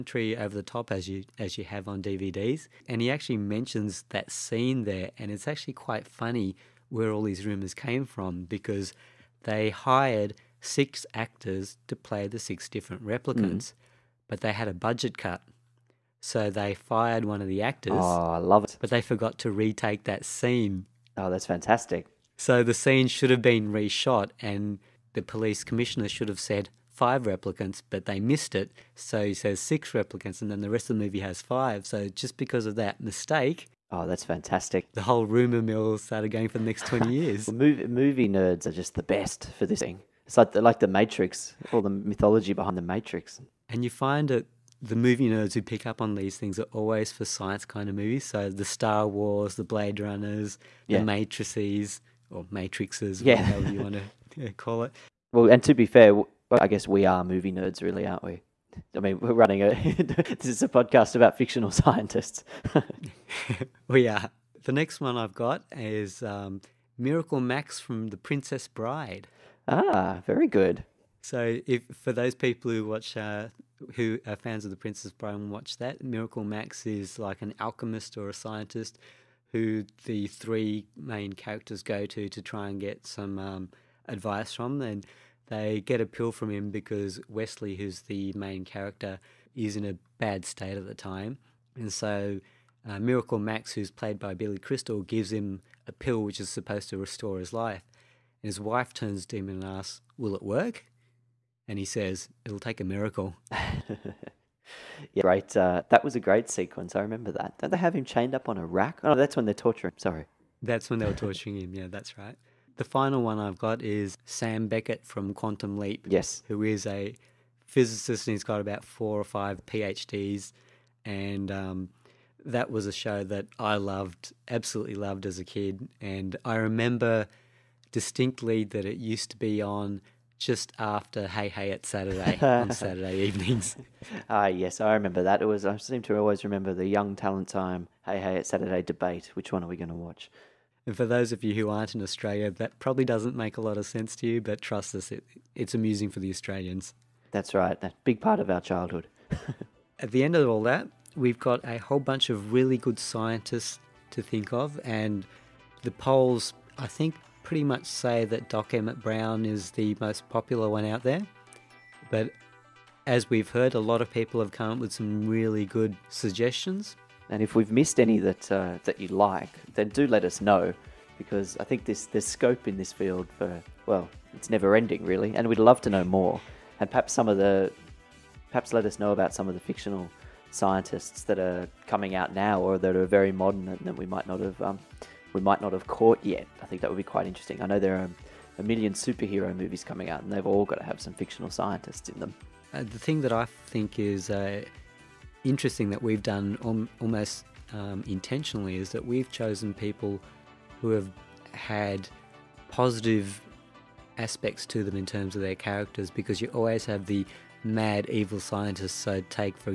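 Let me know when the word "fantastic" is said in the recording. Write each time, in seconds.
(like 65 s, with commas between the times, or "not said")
21 s, 34 s.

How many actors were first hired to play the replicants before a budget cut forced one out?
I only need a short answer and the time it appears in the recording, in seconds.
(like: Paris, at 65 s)
6, at 10 s.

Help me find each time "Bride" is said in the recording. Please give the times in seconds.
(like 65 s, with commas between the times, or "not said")
68 s, 75 s.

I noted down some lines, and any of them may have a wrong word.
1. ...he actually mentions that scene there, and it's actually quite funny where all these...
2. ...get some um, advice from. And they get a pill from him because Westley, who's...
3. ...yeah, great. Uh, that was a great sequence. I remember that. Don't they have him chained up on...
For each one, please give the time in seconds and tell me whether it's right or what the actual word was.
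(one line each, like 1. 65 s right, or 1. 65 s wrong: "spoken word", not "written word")
1. 3 s right
2. 82 s right
3. 105 s right.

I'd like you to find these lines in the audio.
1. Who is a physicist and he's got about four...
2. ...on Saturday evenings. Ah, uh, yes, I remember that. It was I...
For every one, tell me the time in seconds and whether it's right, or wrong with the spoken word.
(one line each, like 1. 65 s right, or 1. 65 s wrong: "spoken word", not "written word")
1. 116 s right
2. 132 s right.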